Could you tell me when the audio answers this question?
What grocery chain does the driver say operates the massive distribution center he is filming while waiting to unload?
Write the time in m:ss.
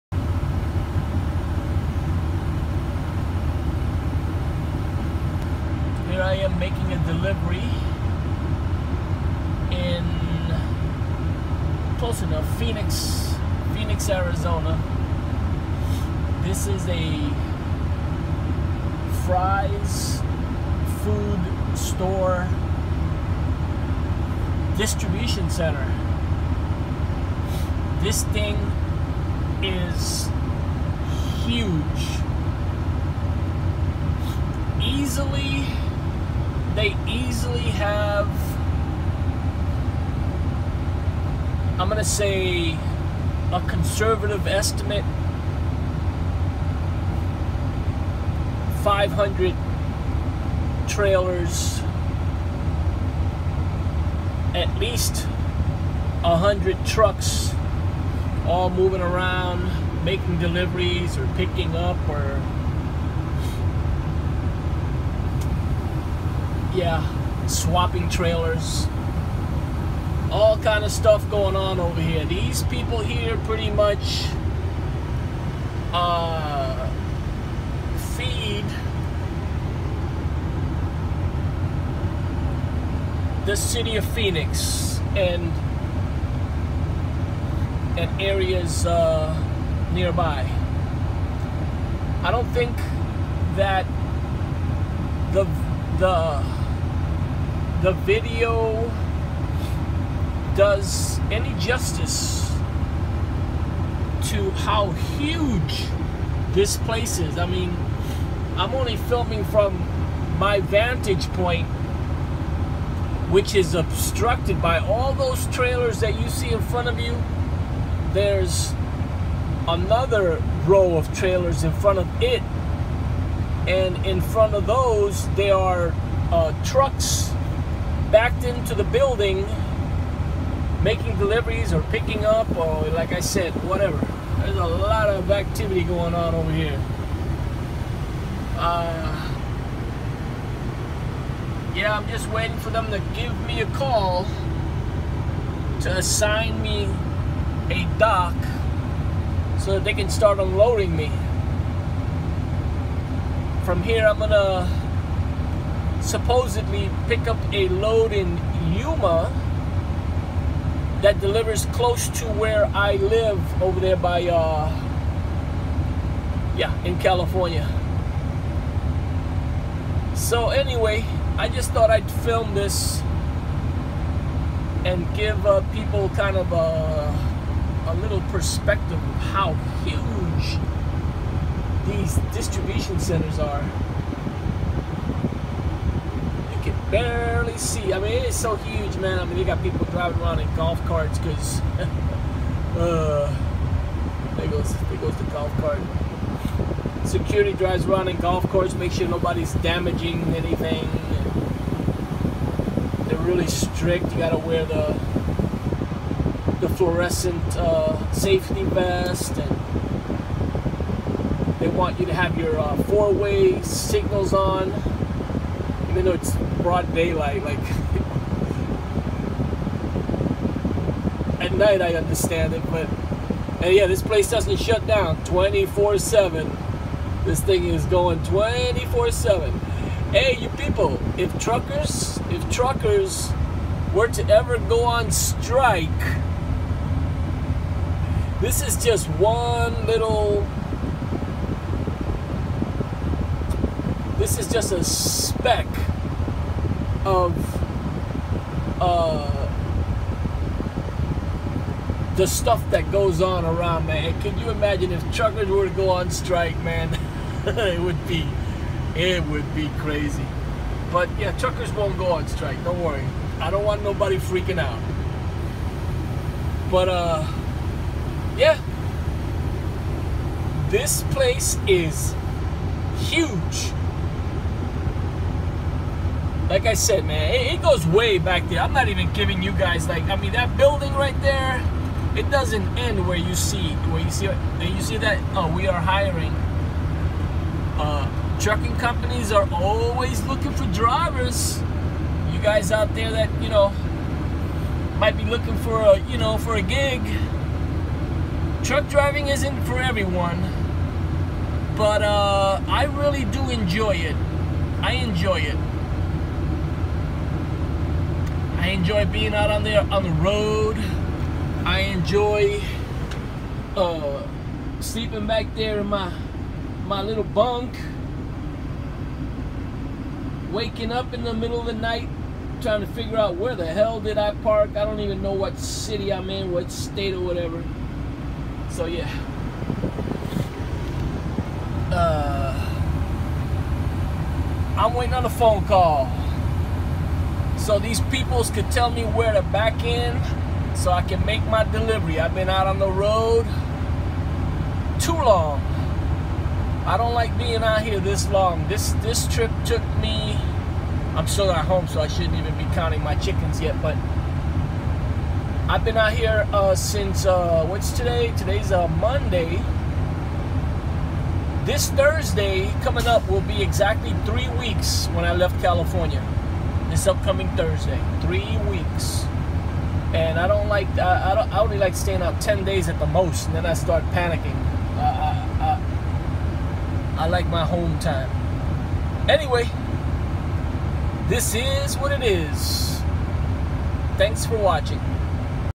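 0:19.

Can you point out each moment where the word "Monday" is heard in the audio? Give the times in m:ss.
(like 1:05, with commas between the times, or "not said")
5:58.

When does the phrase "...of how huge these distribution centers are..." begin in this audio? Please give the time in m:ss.
2:58.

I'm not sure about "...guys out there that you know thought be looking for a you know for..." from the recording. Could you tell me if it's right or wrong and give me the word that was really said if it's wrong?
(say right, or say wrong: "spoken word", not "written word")
wrong: "might", not "thought".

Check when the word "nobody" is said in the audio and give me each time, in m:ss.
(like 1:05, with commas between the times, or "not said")
3:19, 4:23.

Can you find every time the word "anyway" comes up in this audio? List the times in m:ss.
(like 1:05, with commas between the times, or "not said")
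2:50, 6:19.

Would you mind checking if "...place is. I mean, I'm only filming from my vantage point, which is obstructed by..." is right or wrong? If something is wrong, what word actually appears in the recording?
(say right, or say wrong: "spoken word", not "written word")
right.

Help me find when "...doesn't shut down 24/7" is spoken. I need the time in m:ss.
3:44.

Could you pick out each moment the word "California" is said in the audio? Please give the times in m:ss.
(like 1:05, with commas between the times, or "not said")
2:46, 6:05.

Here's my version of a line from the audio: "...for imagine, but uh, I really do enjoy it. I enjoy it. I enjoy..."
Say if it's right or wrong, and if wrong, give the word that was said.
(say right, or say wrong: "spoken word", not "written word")
wrong: "everyone", not "imagine".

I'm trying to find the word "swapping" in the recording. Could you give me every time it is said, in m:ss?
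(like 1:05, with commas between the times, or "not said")
1:07.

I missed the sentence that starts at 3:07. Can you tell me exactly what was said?
I mean, it's so huge, man.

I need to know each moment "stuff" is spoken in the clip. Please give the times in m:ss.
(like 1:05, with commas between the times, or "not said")
1:10, 4:12.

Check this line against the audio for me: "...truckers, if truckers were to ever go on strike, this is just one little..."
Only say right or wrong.
right.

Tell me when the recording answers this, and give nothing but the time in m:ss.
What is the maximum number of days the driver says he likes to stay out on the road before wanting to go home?
6:12.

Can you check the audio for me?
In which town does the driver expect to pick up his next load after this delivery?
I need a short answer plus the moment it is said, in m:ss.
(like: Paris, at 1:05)
Yuma, at 2:38.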